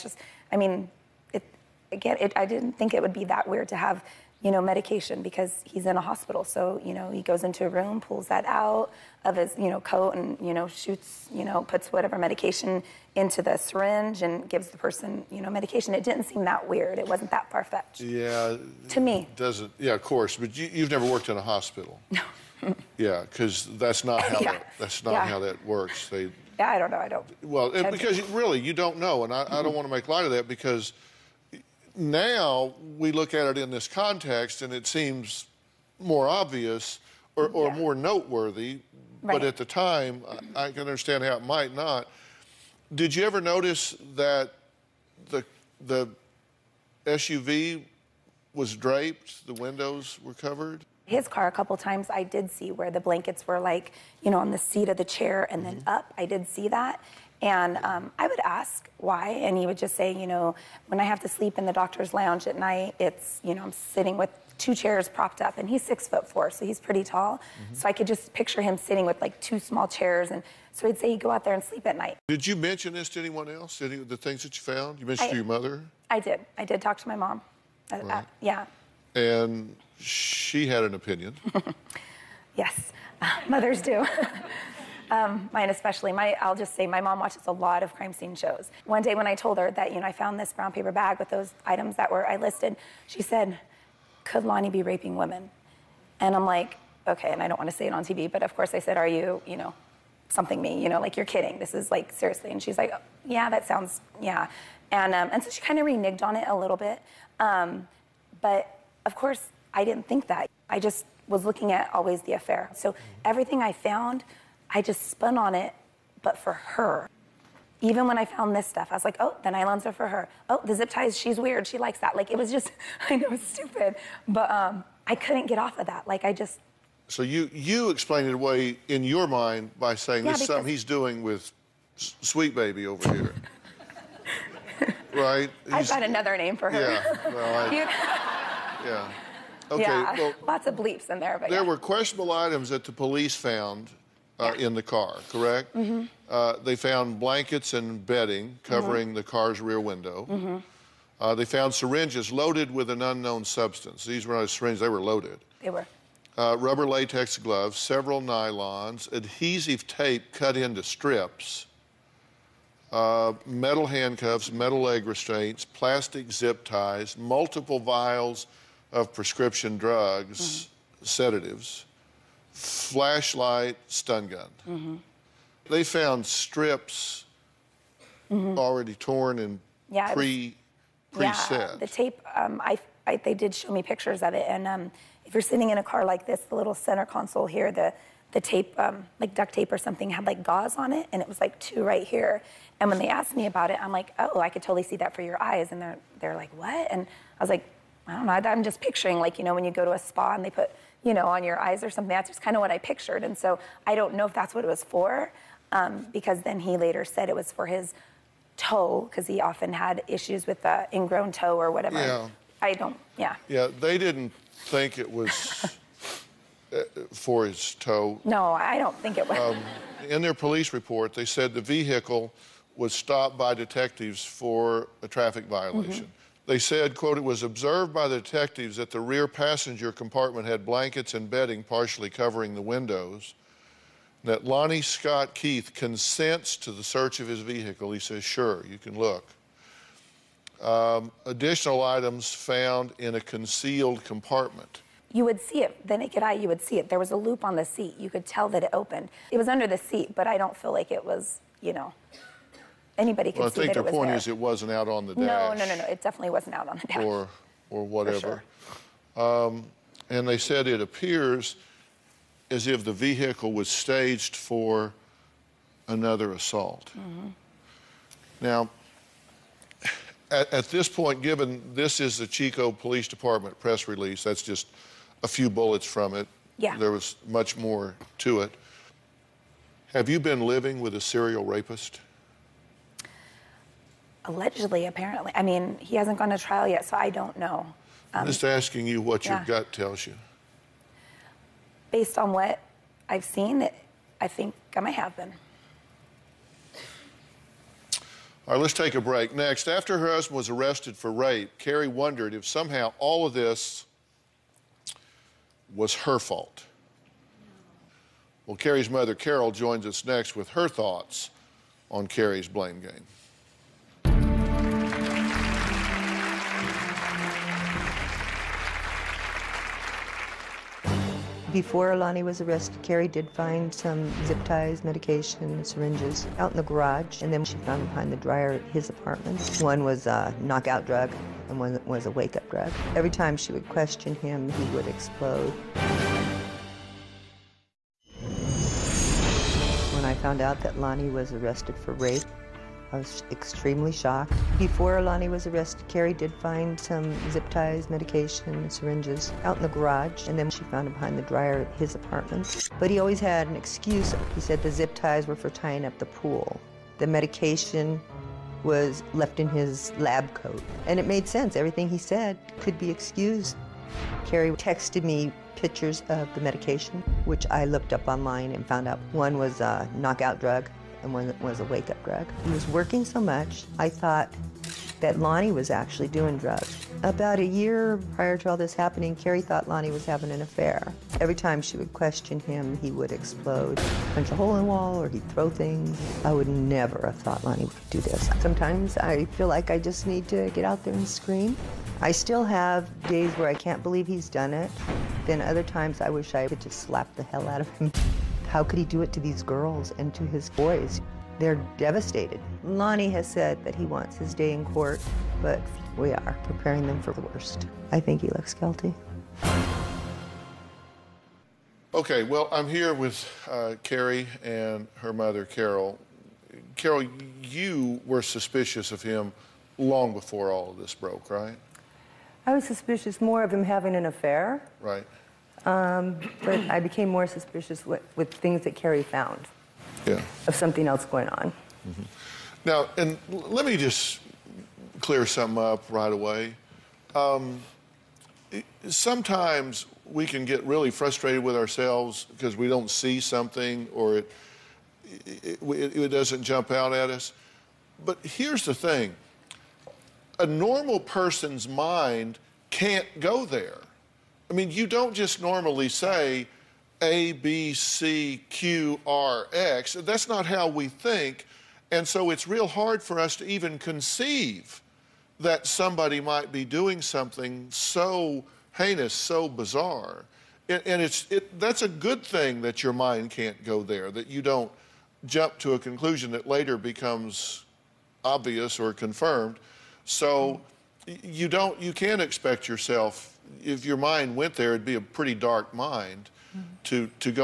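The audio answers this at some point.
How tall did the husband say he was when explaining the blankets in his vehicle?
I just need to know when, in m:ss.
1:05.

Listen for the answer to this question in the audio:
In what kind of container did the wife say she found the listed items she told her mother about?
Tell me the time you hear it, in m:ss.
1:30.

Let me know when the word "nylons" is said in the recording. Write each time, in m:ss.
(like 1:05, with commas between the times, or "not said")
1:59, 2:38.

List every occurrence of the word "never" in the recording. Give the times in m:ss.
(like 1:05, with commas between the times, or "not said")
0:20, 6:26.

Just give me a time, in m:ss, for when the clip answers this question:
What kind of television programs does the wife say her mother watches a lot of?
1:27.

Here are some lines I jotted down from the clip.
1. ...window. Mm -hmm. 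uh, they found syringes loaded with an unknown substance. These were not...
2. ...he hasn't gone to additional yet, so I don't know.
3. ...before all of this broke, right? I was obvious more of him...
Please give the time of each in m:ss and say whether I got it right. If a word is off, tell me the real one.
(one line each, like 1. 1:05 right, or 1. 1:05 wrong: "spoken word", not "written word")
1. 2:29 right
2. 4:45 wrong: "trial", not "additional"
3. 7:00 wrong: "suspicious", not "obvious".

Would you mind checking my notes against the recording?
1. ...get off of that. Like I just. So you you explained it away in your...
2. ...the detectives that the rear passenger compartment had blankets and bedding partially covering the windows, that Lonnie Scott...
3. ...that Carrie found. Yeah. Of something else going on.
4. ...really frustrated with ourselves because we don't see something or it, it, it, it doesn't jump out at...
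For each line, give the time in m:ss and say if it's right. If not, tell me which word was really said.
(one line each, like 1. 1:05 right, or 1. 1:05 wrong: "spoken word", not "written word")
1. 2:05 right
2. 3:48 right
3. 7:08 right
4. 7:20 right.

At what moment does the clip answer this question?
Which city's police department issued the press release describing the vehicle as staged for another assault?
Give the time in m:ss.
4:32.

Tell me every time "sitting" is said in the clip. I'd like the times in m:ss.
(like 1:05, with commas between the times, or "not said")
1:03, 1:08, 3:05.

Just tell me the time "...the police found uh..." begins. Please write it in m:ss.
2:22.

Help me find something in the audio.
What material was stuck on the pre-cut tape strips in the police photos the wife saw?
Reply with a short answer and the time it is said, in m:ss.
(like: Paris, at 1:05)
gauze, at 3:10.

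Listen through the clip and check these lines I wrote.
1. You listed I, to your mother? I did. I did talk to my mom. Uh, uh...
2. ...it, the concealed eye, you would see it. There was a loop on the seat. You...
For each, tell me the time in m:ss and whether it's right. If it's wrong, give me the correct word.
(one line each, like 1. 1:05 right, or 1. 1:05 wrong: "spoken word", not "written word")
1. 1:14 wrong: "mentioned", not "listed"
2. 4:05 wrong: "naked", not "concealed".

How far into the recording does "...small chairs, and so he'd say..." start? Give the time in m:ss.
1:09.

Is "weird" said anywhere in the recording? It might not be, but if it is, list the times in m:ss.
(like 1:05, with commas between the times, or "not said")
0:03, 0:16, 2:01.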